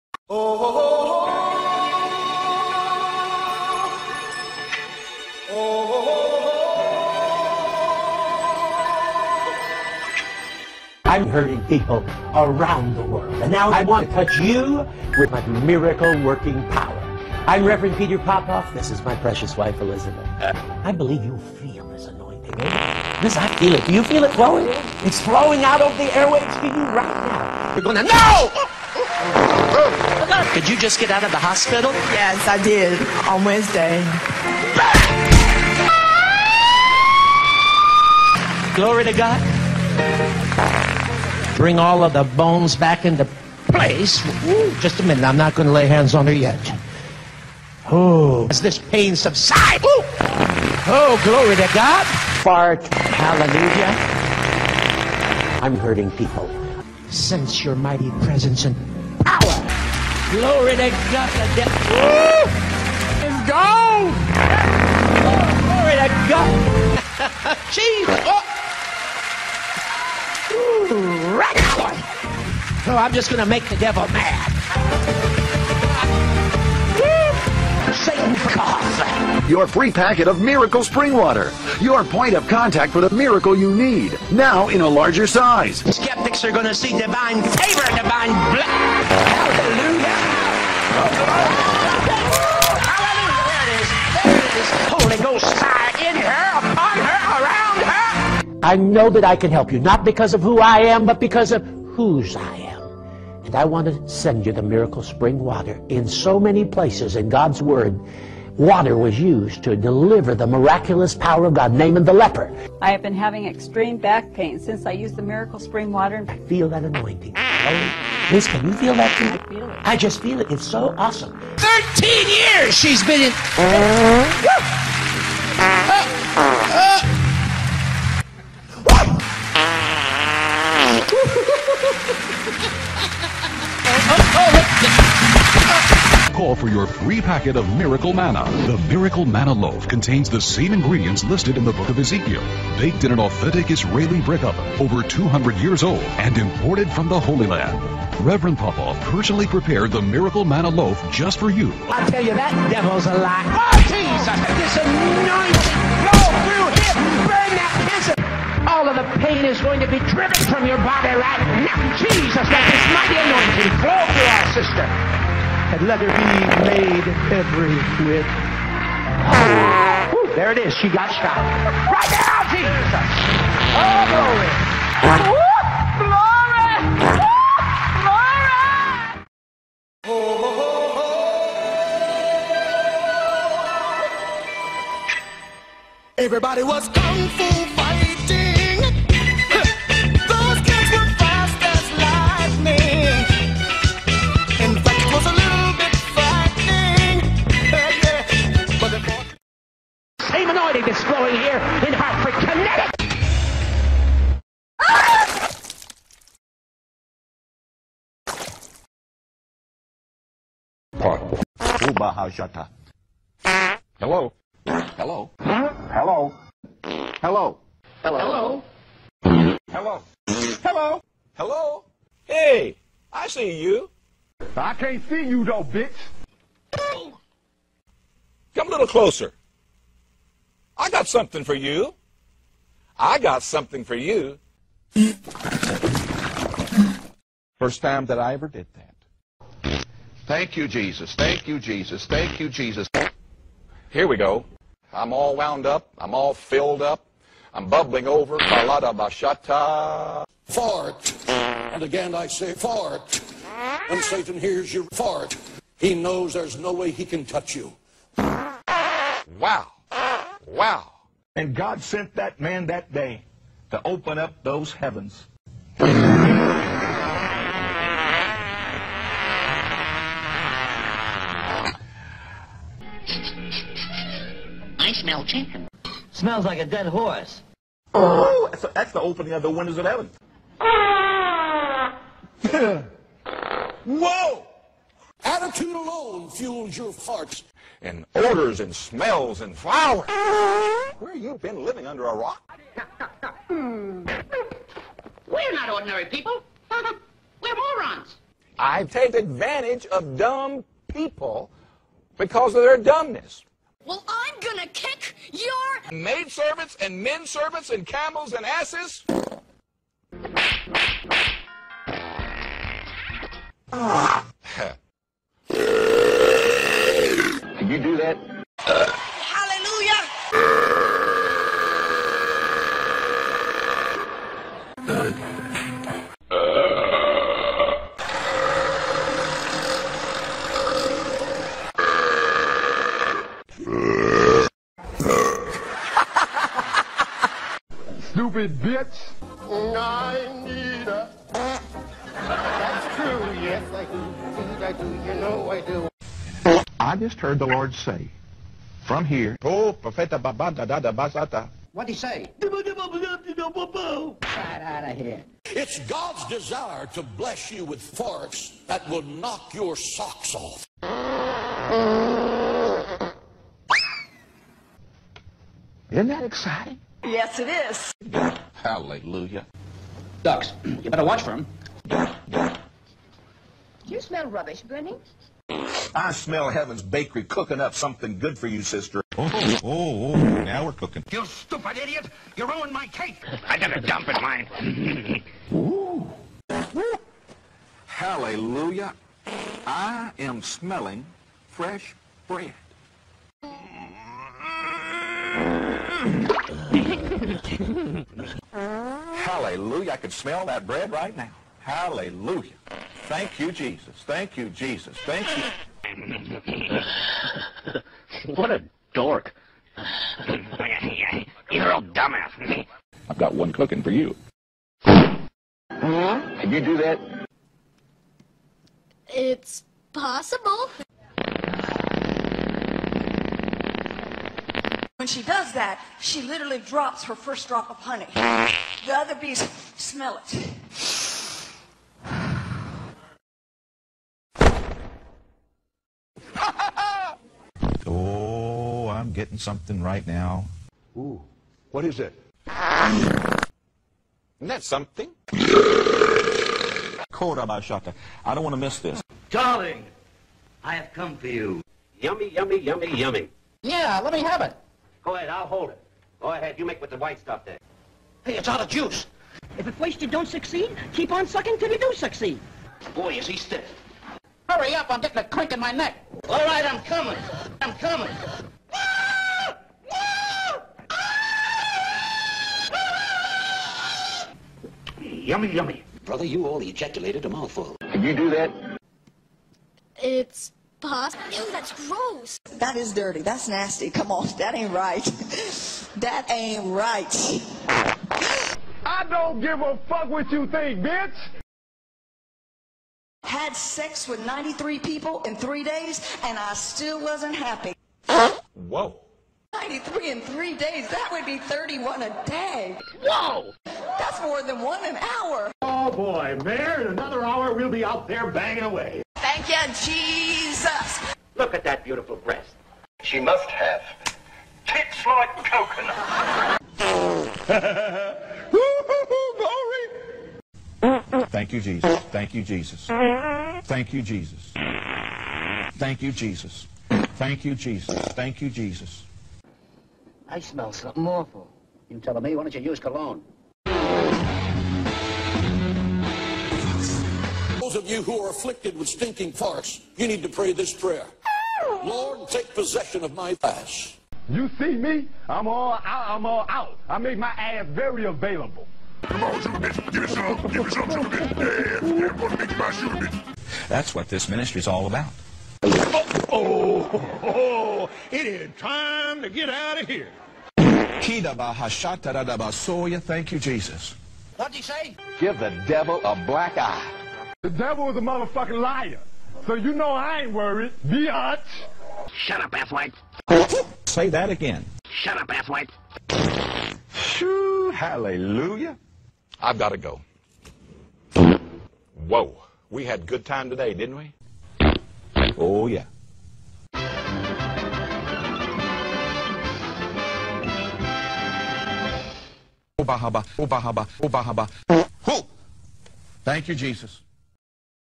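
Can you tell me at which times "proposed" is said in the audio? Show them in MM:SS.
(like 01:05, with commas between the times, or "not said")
not said.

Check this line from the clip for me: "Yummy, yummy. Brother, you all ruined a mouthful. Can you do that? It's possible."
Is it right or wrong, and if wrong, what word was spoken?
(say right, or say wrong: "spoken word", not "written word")
wrong: "ejaculated", not "ruined".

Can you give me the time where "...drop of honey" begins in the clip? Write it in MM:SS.
07:07.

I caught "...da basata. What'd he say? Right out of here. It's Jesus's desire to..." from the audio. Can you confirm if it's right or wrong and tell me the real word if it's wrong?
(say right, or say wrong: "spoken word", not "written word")
wrong: "God", not "Jesus".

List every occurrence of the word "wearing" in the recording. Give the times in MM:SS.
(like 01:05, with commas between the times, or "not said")
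not said.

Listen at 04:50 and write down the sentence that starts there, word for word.
Where you been living under a rock?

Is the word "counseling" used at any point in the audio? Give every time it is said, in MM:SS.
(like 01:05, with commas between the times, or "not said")
not said.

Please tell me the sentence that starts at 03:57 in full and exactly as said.
First time that I ever did that.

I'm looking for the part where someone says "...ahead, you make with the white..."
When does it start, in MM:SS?
07:36.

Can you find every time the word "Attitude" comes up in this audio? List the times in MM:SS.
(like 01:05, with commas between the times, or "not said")
04:45.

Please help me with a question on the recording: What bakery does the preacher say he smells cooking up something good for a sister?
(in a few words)
Heaven's Bakery.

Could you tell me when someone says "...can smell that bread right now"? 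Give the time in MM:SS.
06:40.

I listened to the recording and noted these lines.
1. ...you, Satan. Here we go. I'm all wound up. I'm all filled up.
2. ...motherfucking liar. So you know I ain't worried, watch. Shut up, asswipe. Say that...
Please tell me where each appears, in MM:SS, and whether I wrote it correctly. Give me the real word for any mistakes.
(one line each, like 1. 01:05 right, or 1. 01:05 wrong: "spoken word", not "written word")
1. 04:02 wrong: "Jesus", not "Satan"
2. 09:27 wrong: "biatch", not "watch".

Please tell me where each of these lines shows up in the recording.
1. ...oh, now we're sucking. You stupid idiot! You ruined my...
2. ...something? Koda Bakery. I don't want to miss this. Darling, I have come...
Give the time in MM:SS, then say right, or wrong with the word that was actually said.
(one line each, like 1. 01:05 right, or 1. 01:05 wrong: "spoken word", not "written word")
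1. 06:19 wrong: "cooking", not "sucking"
2. 07:24 wrong: "Bashaka", not "Bakery".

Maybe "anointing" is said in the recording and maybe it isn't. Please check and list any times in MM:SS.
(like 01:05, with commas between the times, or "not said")
00:22, 01:56, 02:34, 02:43.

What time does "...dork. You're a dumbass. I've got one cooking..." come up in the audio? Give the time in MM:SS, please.
06:48.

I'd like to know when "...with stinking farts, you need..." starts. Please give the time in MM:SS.
08:58.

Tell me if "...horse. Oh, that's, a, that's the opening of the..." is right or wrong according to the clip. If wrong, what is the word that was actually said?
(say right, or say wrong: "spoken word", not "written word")
right.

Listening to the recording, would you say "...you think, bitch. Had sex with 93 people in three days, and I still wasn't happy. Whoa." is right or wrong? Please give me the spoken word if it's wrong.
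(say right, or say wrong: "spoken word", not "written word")
right.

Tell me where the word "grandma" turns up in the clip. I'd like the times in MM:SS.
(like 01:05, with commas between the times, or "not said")
not said.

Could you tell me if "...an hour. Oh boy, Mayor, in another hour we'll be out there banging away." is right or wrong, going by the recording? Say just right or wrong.
right.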